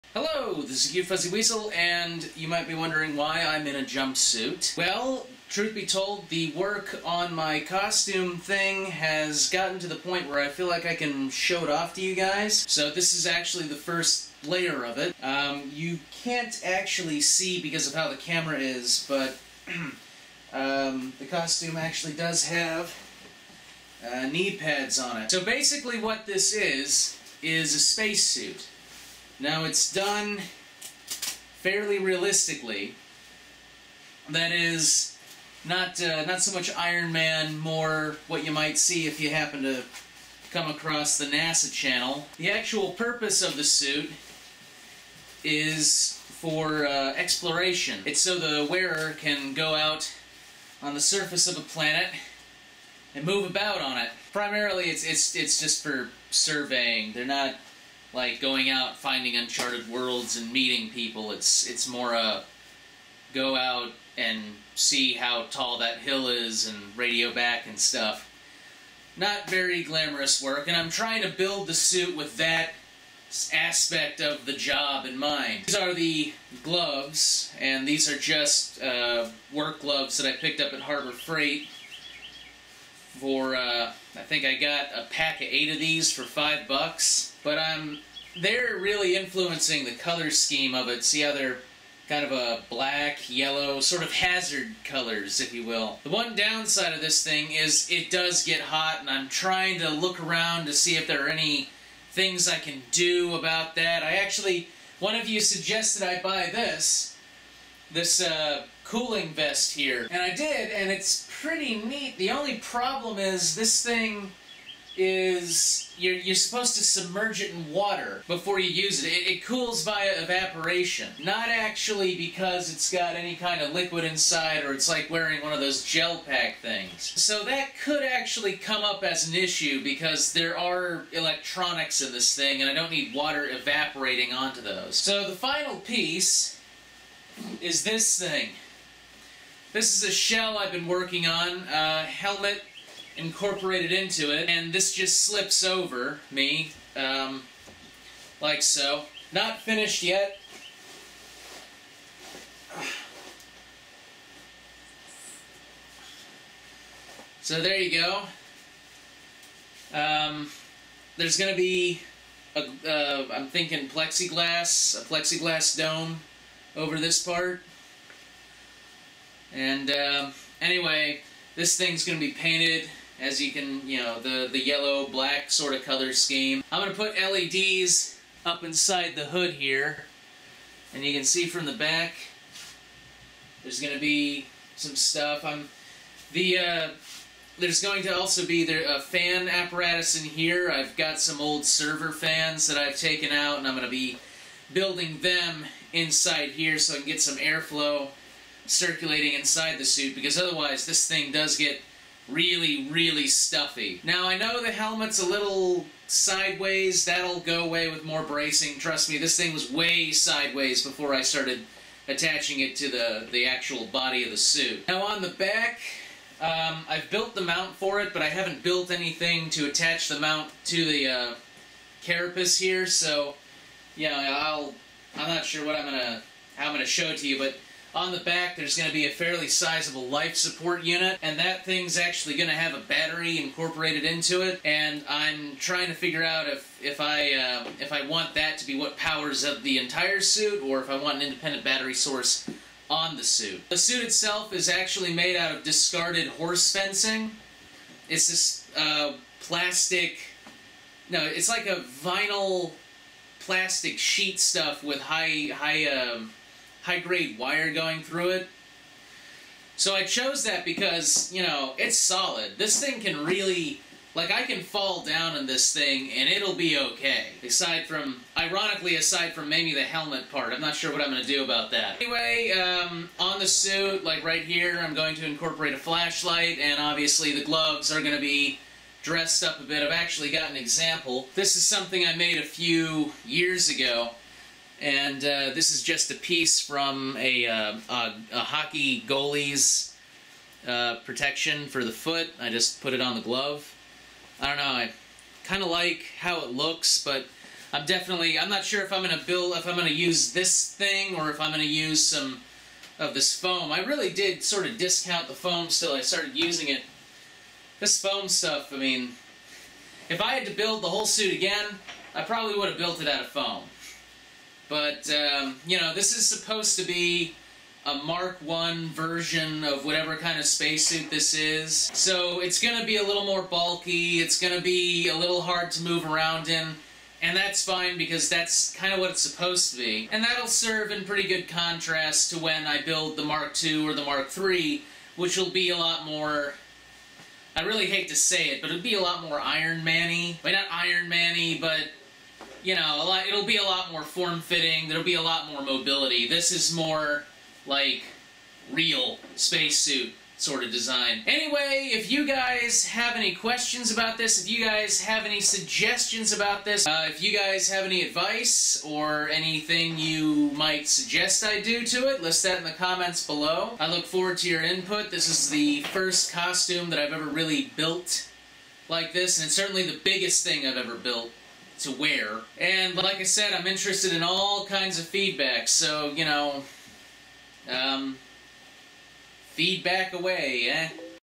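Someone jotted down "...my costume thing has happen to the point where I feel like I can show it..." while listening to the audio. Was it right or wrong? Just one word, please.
wrong.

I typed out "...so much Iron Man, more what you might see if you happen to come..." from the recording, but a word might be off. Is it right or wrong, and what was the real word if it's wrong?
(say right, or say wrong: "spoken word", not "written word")
right.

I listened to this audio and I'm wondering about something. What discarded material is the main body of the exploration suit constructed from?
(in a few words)
horse fencing.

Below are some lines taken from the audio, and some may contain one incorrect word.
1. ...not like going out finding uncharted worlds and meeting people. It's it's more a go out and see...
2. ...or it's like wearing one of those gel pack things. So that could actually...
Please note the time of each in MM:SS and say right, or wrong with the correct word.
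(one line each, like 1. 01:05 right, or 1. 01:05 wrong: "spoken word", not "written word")
1. 00:57 right
2. 02:04 right.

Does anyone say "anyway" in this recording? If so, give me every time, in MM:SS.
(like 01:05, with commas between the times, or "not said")
02:50, 04:31, 05:51.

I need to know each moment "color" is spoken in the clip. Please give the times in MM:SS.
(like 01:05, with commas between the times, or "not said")
01:29, 01:34, 02:55.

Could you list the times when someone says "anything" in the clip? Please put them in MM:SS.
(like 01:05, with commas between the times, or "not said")
03:38, 05:59.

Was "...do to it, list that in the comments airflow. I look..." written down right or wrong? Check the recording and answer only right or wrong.
wrong.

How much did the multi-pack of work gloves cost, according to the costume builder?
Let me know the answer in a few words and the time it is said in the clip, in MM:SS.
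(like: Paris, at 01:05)
5 bucks, at 01:26.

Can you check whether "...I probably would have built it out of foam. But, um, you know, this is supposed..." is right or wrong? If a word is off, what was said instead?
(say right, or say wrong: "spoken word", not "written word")
right.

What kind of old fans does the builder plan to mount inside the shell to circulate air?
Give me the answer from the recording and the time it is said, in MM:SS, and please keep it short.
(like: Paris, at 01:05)
server fans, at 03:11.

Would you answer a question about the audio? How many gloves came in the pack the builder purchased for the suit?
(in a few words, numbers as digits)
8.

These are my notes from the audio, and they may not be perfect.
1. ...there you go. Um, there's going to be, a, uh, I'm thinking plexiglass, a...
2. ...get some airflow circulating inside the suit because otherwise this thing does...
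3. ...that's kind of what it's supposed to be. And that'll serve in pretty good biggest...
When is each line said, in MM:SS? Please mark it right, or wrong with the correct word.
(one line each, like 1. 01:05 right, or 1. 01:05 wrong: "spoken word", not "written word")
1. 02:37 right
2. 03:17 right
3. 05:28 wrong: "contrast", not "biggest".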